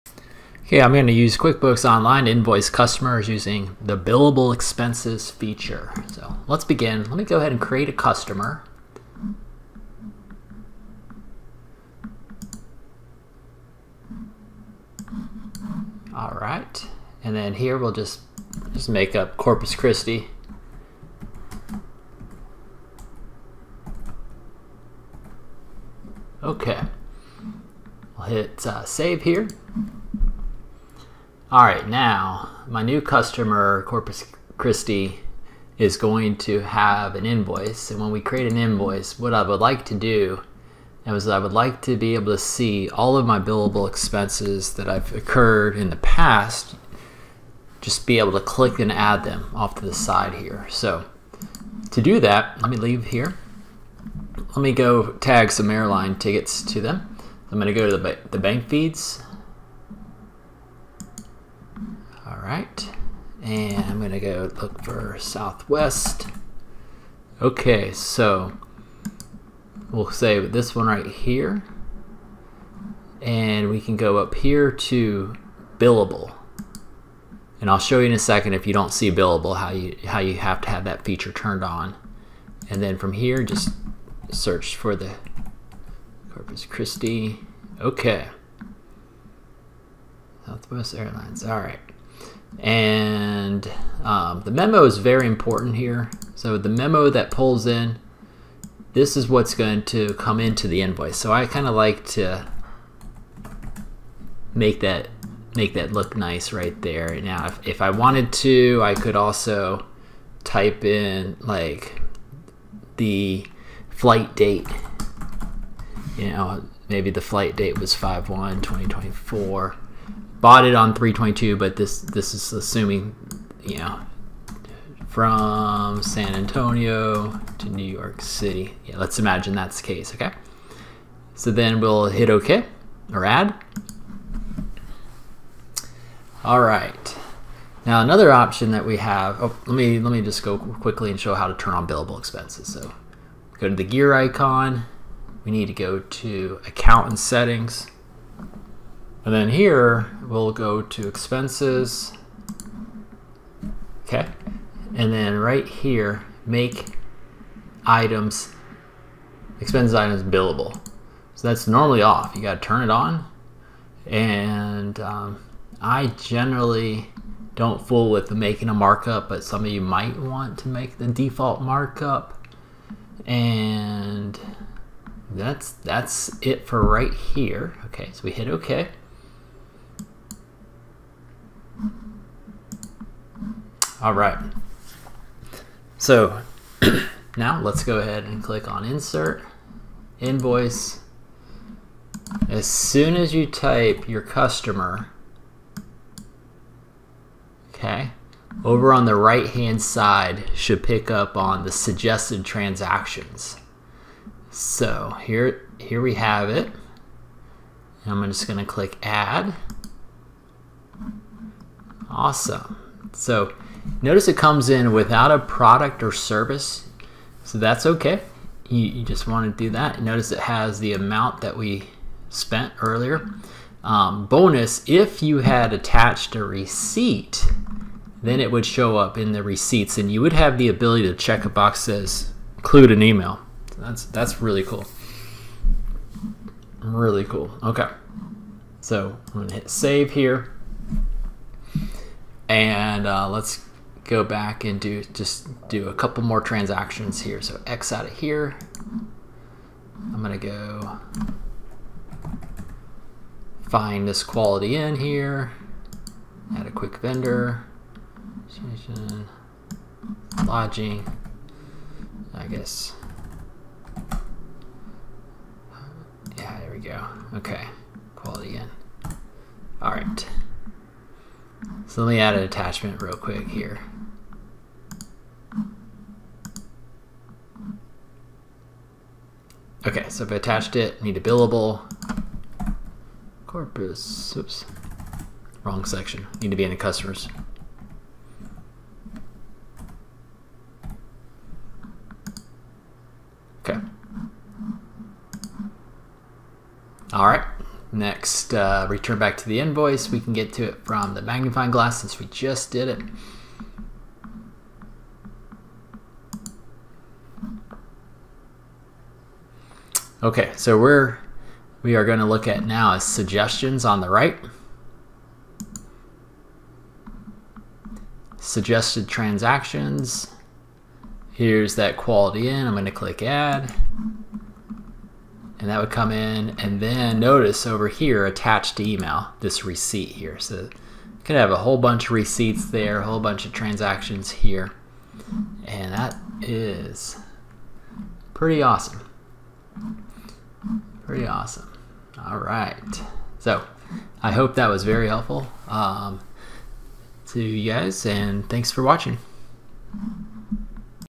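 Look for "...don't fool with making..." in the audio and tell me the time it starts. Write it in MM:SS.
02:47.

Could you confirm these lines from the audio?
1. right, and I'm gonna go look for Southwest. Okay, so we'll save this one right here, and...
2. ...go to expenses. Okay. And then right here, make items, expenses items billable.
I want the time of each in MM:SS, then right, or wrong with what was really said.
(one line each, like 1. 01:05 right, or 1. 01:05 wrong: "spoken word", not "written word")
1. 01:02 right
2. 02:30 right.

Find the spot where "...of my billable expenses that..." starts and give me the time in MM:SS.
00:43.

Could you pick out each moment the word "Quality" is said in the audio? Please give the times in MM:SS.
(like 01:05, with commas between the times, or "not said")
04:14, 04:28, 05:21.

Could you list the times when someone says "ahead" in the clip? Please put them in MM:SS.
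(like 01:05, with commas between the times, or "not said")
00:07, 03:07.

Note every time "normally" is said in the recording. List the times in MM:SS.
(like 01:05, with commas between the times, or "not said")
02:41.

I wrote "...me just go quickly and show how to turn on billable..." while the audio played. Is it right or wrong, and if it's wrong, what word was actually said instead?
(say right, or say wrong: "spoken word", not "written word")
right.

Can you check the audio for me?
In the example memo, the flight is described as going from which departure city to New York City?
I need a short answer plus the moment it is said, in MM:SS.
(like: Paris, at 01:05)
San Antonio, at 02:06.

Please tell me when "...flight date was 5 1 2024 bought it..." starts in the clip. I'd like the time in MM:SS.
01:57.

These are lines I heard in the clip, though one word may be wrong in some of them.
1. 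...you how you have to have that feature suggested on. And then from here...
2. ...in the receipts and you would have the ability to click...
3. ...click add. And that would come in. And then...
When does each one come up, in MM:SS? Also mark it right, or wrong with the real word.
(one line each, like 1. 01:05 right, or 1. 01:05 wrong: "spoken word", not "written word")
1. 01:19 wrong: "turned", not "suggested"
2. 03:49 wrong: "check", not "click"
3. 05:22 right.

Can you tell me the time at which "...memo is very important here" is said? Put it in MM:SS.
01:34.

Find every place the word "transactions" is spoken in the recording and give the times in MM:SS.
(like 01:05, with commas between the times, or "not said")
03:22, 04:06, 05:19, 05:33.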